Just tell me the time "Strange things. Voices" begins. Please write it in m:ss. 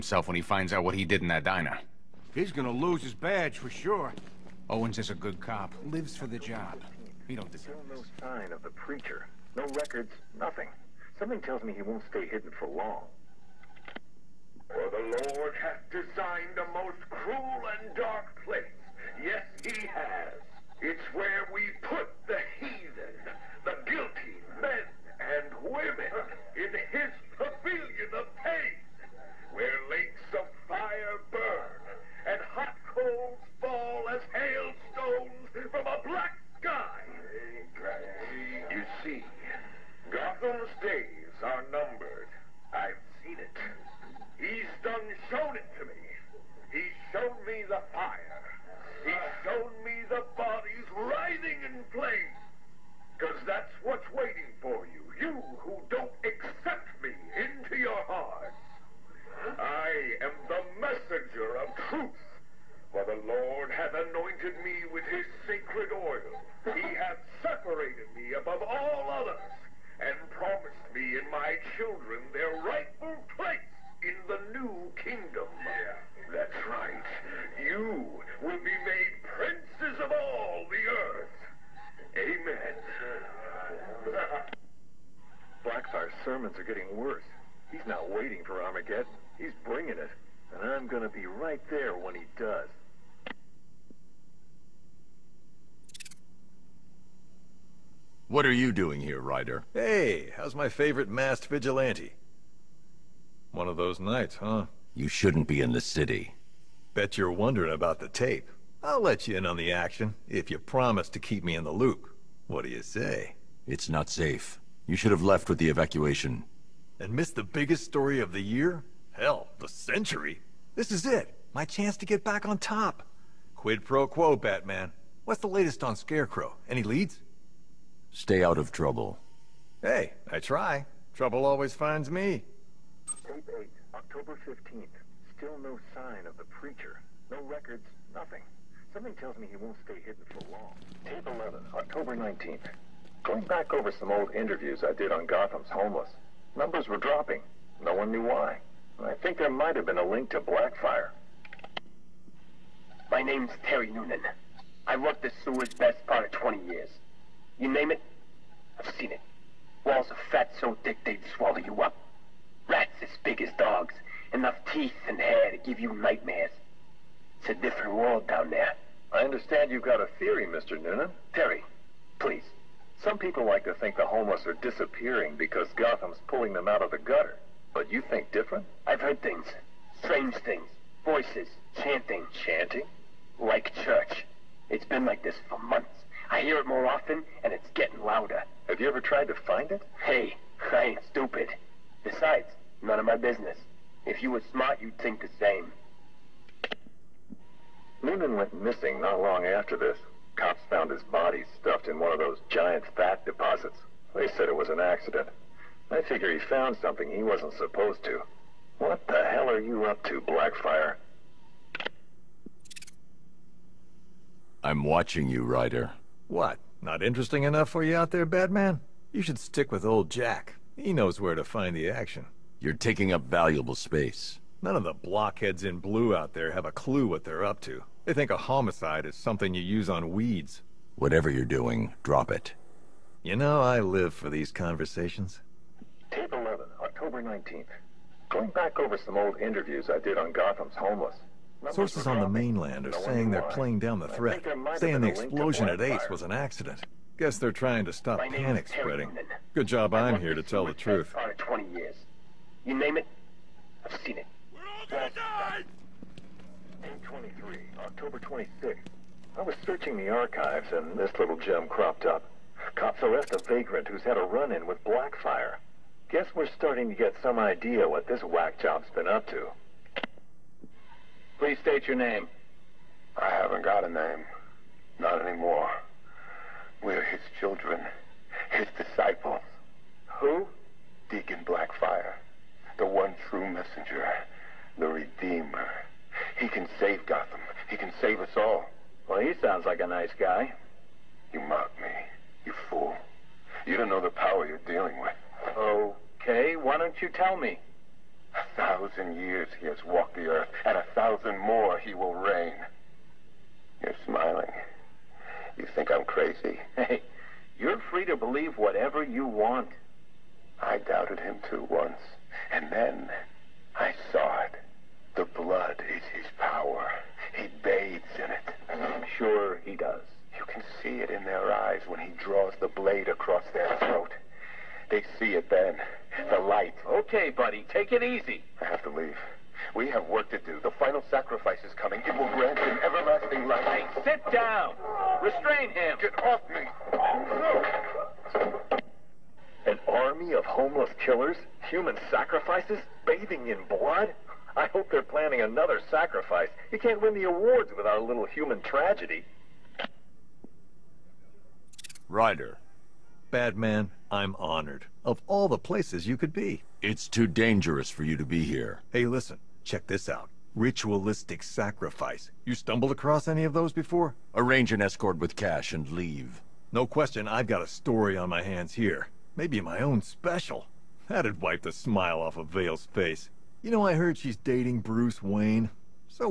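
3:00.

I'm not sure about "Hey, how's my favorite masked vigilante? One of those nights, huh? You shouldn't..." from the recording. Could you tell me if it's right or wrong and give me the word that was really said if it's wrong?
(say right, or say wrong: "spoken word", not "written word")
right.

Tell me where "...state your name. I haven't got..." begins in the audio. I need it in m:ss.
4:31.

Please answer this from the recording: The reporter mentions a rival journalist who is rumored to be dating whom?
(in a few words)
Bruce Wayne.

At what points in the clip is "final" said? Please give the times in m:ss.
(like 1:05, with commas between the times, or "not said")
5:30.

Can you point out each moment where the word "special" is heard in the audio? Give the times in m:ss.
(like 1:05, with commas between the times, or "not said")
6:10.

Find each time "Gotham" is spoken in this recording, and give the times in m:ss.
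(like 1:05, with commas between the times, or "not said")
2:25, 2:55, 4:00, 4:47.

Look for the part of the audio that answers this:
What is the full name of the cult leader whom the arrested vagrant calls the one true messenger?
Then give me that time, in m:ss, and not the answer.
4:41.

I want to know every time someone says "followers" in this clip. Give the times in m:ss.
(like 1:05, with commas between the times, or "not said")
not said.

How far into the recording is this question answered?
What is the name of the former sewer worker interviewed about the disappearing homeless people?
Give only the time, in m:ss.
2:33.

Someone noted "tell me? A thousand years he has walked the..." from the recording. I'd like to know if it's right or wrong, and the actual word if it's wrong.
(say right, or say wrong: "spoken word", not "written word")
right.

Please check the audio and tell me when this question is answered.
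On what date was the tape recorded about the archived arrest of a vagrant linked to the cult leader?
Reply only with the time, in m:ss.
4:17.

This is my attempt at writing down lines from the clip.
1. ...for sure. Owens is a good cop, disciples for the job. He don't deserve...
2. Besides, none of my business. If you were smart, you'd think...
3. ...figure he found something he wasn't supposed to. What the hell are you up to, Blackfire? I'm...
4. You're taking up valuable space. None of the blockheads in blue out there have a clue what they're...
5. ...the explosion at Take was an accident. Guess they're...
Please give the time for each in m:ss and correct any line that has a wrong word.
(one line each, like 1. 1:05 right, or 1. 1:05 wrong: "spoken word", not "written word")
1. 0:03 wrong: "lives", not "disciples"
2. 3:12 right
3. 3:25 right
4. 3:42 right
5. 4:04 wrong: "Ace", not "Take".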